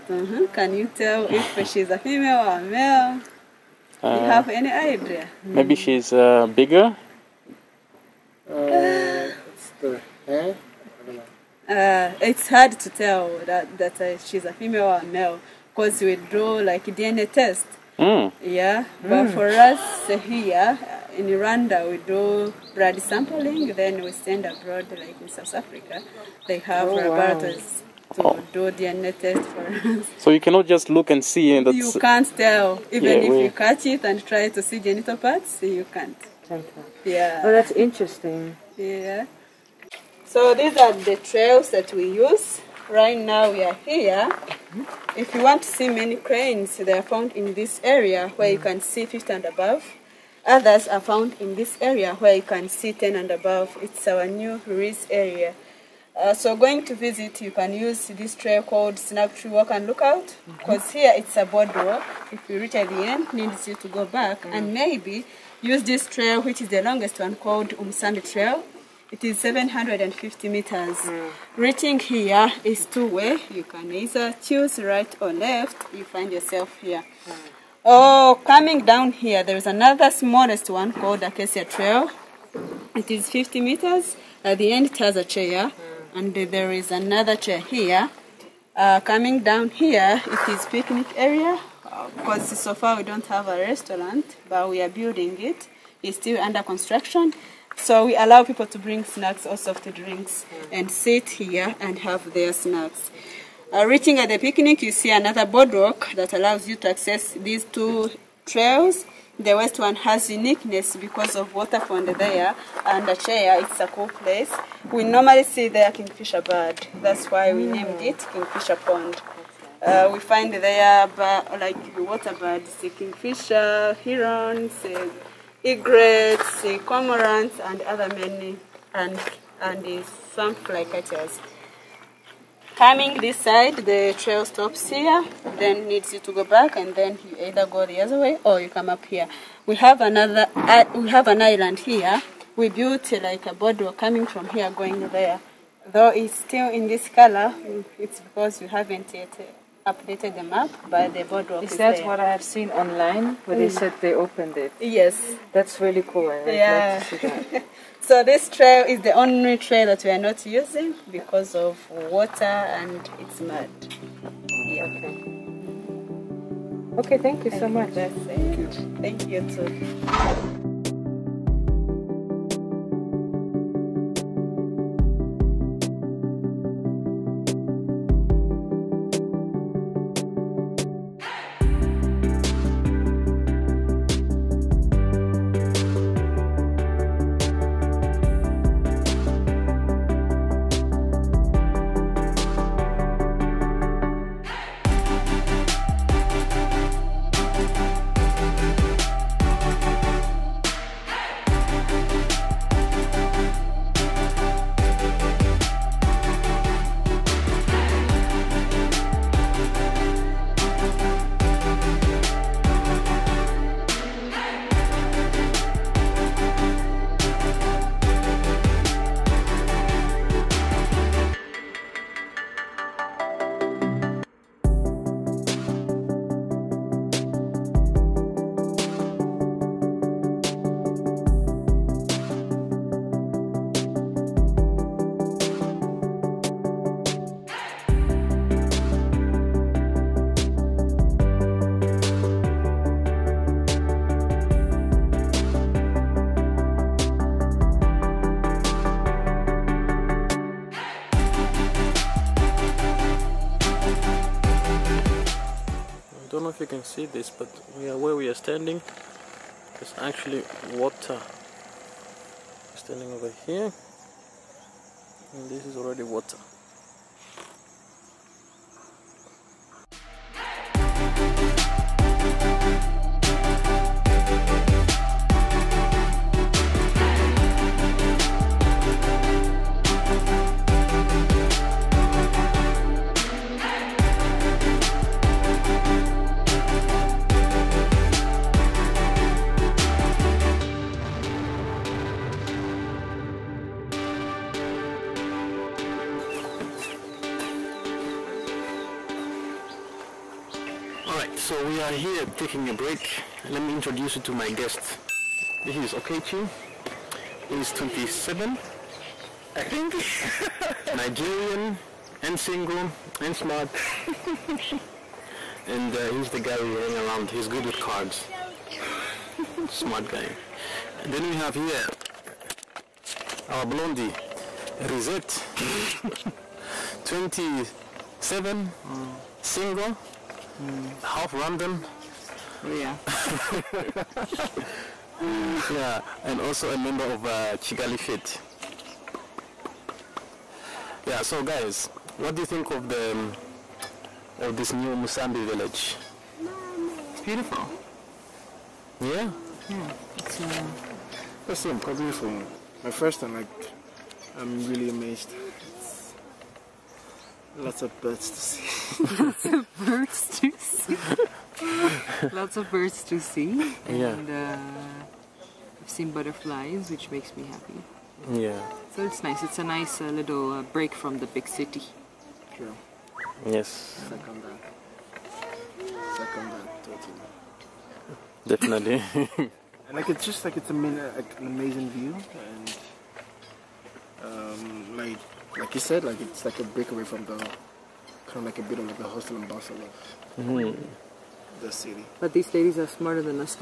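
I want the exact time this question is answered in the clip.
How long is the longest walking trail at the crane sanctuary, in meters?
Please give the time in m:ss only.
1:09.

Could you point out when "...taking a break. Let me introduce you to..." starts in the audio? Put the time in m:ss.
5:02.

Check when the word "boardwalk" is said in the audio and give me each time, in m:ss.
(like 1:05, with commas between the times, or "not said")
1:01, 1:45, 2:23, 2:31.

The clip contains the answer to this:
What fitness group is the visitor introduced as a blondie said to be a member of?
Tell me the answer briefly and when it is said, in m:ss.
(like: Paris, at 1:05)
Kigali Fit, at 5:37.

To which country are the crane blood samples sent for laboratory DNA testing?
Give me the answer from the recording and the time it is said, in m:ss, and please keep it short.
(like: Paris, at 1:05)
South Africa, at 0:25.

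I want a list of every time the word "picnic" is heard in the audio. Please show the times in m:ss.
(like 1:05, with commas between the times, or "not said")
1:30, 1:44.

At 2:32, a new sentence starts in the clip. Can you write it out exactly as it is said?
what I have seen online where mm.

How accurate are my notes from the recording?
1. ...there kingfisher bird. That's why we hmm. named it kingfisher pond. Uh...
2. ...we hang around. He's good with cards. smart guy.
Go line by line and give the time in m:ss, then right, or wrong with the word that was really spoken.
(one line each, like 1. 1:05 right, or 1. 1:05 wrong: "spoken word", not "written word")
1. 1:55 right
2. 5:16 right.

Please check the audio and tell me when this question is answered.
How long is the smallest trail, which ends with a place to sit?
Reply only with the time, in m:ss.
1:23.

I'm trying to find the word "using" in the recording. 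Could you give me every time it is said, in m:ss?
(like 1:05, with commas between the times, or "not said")
2:40.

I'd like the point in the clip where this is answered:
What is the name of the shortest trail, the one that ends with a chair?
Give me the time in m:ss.
1:21.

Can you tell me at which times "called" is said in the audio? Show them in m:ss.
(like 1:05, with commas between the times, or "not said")
0:58, 1:07, 1:20.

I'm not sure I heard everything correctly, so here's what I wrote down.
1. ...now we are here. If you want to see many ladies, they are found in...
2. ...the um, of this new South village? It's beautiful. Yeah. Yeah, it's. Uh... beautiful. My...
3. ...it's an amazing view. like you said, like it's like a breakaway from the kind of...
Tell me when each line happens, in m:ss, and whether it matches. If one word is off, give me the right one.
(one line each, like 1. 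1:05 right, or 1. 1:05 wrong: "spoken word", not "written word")
1. 0:43 wrong: "cranes", not "ladies"
2. 5:42 wrong: "Musambi", not "South"
3. 6:20 right.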